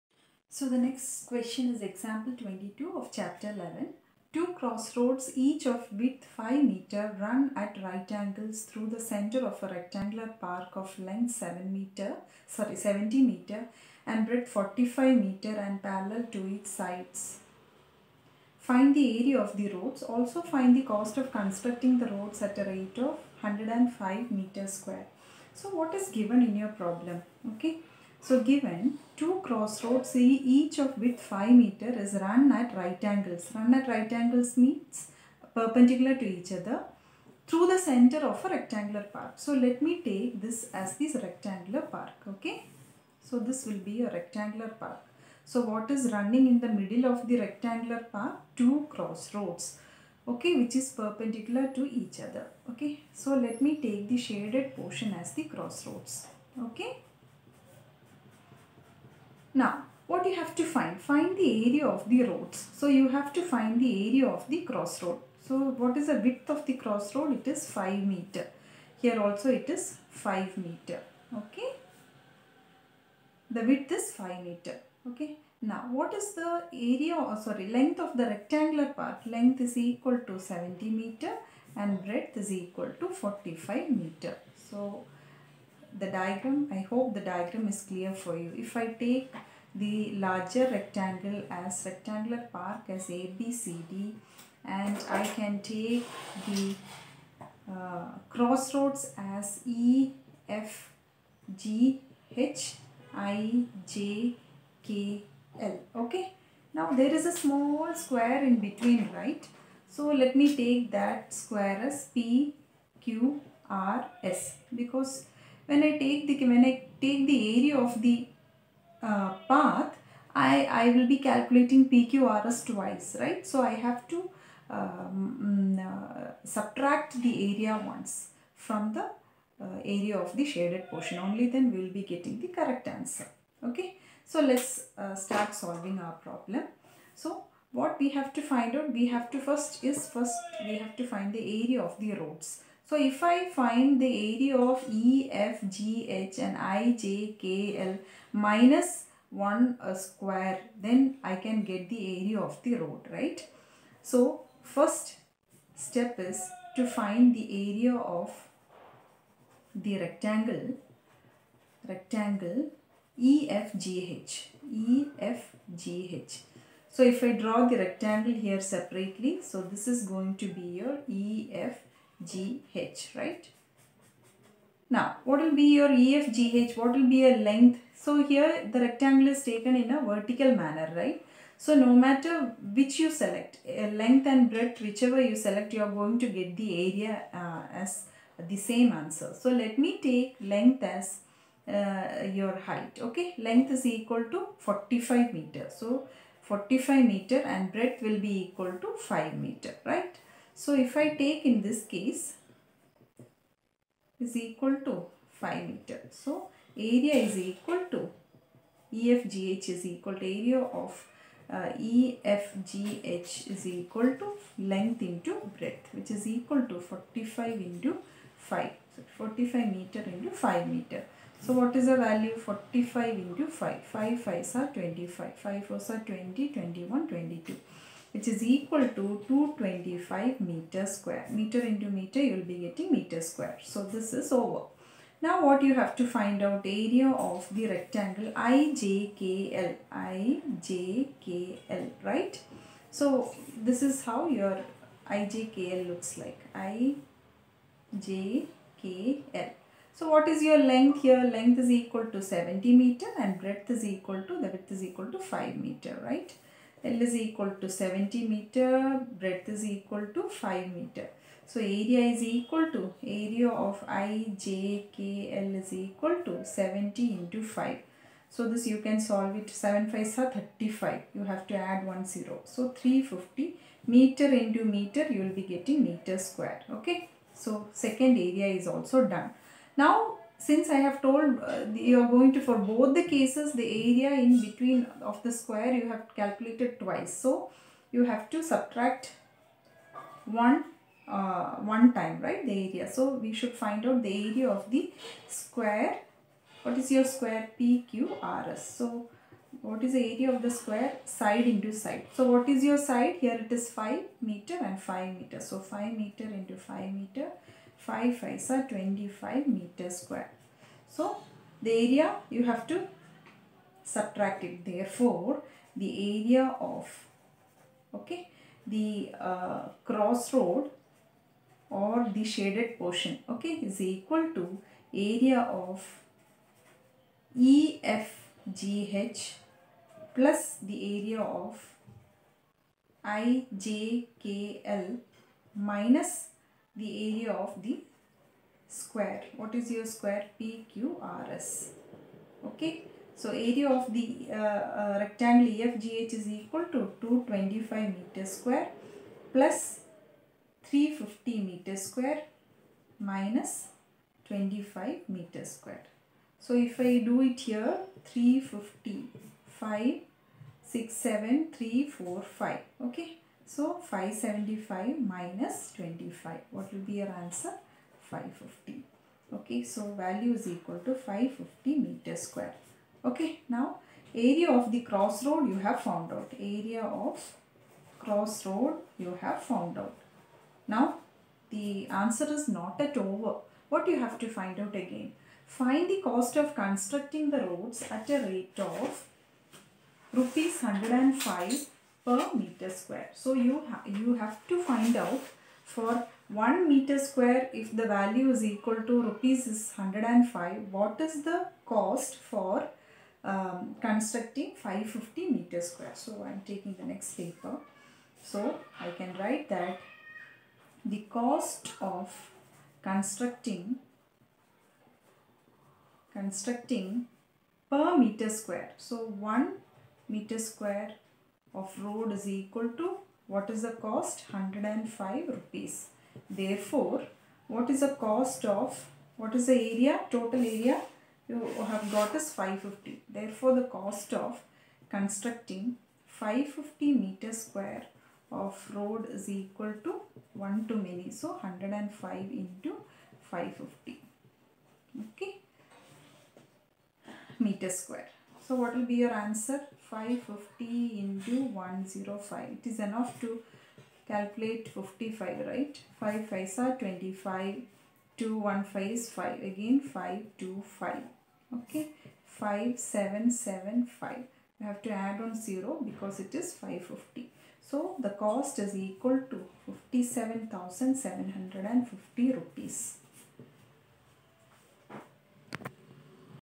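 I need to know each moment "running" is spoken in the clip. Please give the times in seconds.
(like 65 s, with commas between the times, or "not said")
46 s.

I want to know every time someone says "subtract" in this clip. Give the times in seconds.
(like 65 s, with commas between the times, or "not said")
126 s, 288 s, 313 s.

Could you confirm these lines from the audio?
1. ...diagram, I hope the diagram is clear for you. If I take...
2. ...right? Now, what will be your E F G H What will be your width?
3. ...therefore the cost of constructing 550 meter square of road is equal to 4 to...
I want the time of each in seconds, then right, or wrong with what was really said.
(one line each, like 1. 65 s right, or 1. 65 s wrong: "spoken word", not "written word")
1. 86 s right
2. 173 s wrong: "length", not "width"
3. 433 s wrong: "1", not "4".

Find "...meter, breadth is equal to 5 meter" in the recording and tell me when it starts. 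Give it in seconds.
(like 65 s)
258 s.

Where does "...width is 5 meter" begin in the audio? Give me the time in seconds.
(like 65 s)
73 s.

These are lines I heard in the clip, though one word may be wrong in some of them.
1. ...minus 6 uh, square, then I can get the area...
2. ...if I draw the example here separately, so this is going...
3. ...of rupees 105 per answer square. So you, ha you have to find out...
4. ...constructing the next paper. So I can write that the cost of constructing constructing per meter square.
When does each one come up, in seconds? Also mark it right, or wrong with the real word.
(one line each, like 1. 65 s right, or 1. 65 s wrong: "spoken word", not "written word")
1. 148 s wrong: "1", not "6"
2. 167 s wrong: "rectangle", not "example"
3. 388 s wrong: "meter", not "answer"
4. 406 s wrong: "taking", not "constructing".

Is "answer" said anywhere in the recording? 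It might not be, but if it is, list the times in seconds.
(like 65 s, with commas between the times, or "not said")
132 s, 188 s, 367 s, 381 s, 449 s.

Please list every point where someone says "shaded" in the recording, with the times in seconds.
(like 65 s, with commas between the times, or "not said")
54 s, 130 s, 322 s.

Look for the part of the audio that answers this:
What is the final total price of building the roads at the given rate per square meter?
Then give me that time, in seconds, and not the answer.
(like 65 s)
469 s.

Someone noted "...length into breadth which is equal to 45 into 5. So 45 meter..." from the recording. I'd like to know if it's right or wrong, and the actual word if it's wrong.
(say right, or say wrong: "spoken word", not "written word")
right.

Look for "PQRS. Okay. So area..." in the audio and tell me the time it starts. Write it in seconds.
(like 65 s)
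340 s.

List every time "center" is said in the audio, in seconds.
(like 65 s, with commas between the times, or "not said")
8 s, 37 s.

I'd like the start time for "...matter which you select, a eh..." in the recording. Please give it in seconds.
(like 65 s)
181 s.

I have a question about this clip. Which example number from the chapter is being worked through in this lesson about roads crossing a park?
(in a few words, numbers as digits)
22.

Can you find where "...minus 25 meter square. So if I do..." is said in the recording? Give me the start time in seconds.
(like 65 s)
352 s.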